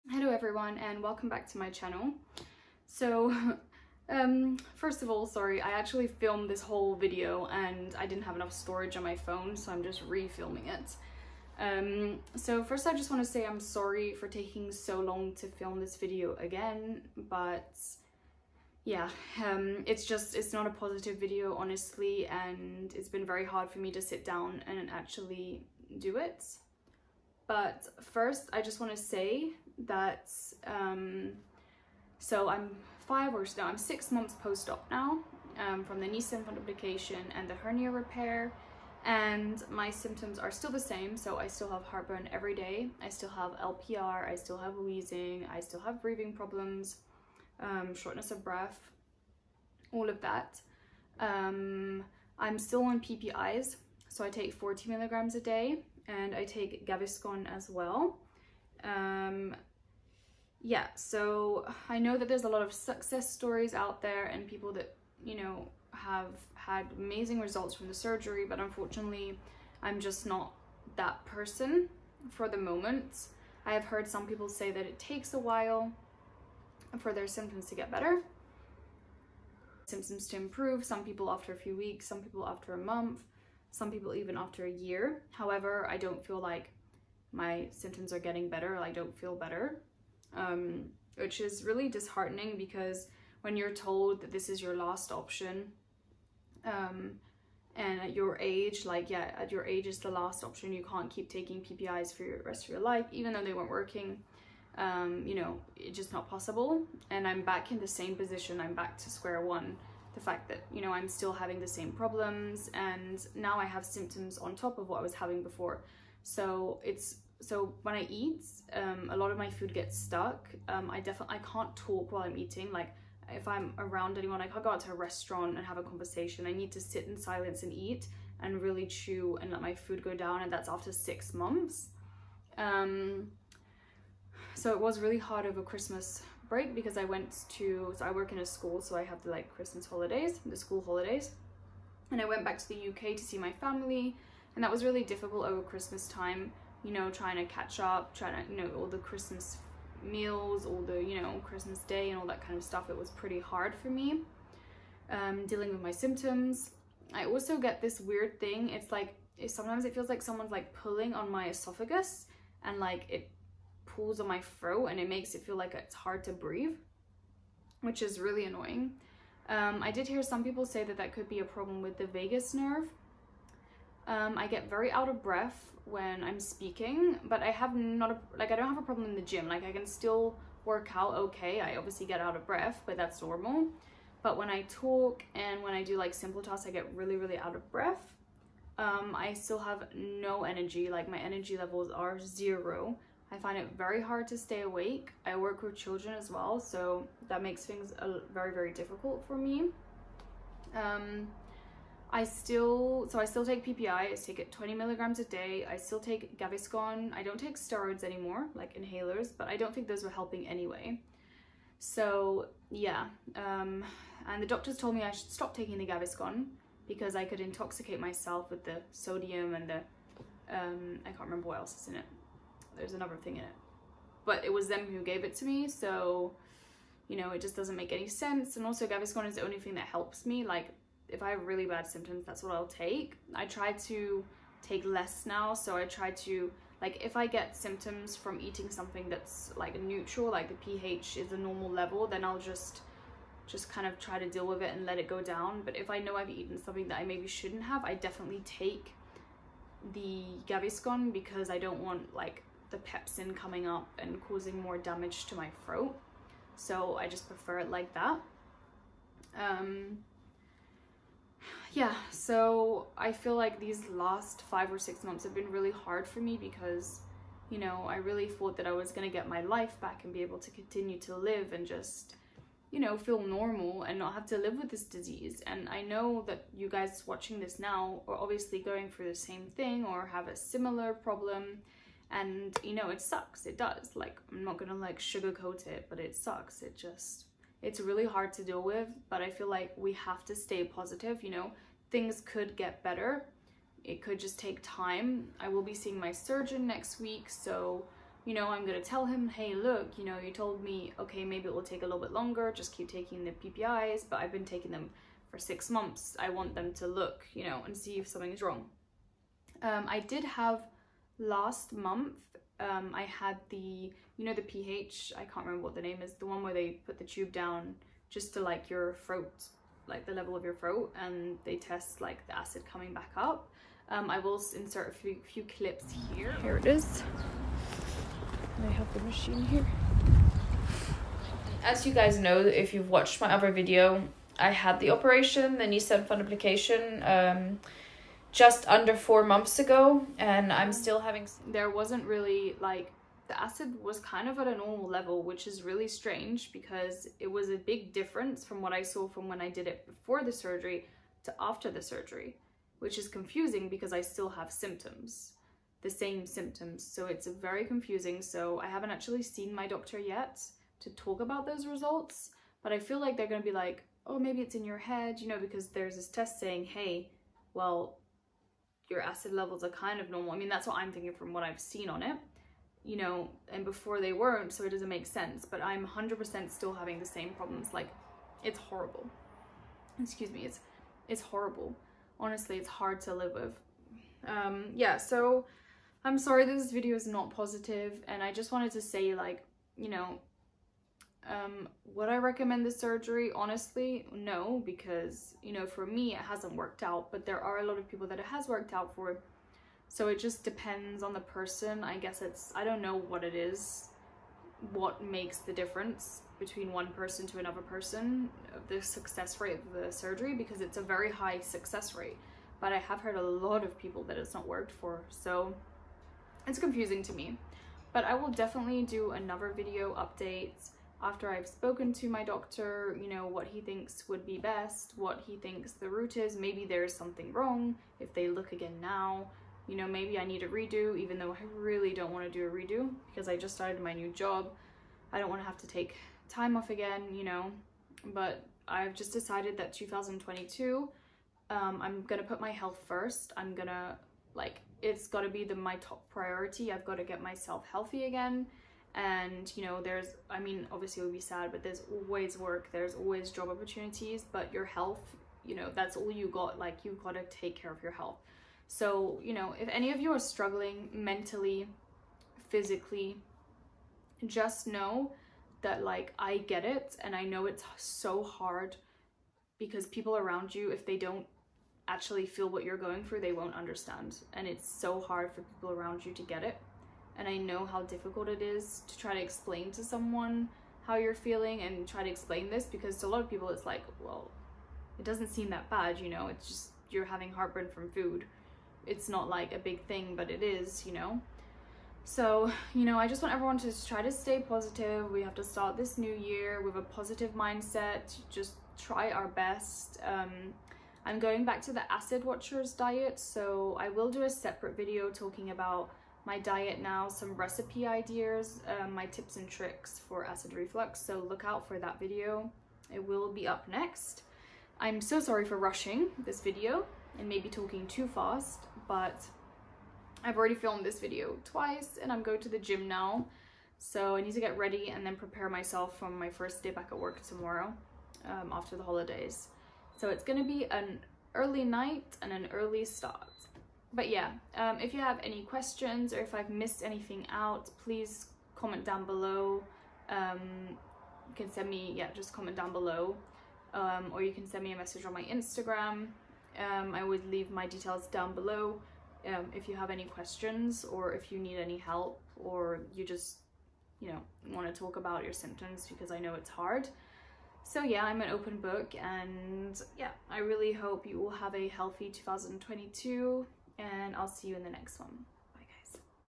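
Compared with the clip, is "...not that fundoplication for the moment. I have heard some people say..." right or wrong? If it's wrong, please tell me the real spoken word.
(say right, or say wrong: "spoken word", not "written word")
wrong: "person", not "fundoplication".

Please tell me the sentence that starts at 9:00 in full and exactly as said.
Um, you can send me, yeah, just comment down below.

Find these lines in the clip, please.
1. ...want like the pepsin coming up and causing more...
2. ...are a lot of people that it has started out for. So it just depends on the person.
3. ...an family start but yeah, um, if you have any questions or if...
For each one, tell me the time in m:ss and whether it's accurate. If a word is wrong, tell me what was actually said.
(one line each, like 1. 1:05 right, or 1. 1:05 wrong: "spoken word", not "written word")
1. 4:11 right
2. 6:37 wrong: "worked", not "started"
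3. 8:52 wrong: "early", not "family".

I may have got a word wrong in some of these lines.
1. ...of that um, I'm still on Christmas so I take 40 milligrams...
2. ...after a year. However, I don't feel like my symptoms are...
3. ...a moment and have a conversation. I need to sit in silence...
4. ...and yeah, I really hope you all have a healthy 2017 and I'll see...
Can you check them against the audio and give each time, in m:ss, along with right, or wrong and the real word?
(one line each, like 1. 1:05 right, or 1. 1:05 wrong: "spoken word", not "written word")
1. 0:50 wrong: "PPIs", not "Christmas"
2. 1:24 right
3. 2:04 wrong: "restaurant", not "moment"
4. 9:19 wrong: "2022", not "2017".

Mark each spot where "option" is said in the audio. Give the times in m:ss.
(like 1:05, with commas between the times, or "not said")
1:35, 1:40.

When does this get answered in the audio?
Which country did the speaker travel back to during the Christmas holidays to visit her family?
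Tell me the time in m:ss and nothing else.
2:22.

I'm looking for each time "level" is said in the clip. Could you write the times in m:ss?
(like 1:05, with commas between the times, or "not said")
3:11, 4:01, 5:20, 5:44, 6:09.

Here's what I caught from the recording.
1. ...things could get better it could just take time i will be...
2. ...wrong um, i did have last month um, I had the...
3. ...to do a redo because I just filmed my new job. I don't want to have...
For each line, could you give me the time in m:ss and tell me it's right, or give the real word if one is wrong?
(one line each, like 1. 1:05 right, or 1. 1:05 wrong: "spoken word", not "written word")
1. 4:51 right
2. 5:08 right
3. 7:12 wrong: "started", not "filmed".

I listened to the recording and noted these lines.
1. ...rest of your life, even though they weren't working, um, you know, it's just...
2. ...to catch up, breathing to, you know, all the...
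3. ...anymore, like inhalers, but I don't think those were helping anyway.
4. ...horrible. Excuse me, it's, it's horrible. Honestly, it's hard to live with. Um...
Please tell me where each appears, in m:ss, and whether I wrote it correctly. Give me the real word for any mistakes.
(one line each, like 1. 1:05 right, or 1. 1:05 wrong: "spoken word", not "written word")
1. 1:42 right
2. 2:27 wrong: "trying", not "breathing"
3. 3:28 right
4. 6:18 right.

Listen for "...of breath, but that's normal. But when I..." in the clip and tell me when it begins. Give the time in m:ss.
3:02.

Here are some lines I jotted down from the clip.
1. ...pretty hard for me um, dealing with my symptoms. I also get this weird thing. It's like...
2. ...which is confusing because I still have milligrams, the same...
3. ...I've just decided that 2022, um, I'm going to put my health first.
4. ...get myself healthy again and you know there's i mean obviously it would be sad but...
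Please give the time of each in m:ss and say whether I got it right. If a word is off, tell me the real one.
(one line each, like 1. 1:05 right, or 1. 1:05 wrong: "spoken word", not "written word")
1. 2:33 right
2. 5:52 wrong: "symptoms", not "milligrams"
3. 7:18 right
4. 7:27 right.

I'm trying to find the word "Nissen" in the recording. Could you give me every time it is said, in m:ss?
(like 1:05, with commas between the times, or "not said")
0:36, 5:35.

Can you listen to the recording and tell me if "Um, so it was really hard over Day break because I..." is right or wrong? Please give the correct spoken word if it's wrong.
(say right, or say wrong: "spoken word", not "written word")
wrong: "Christmas", not "Day".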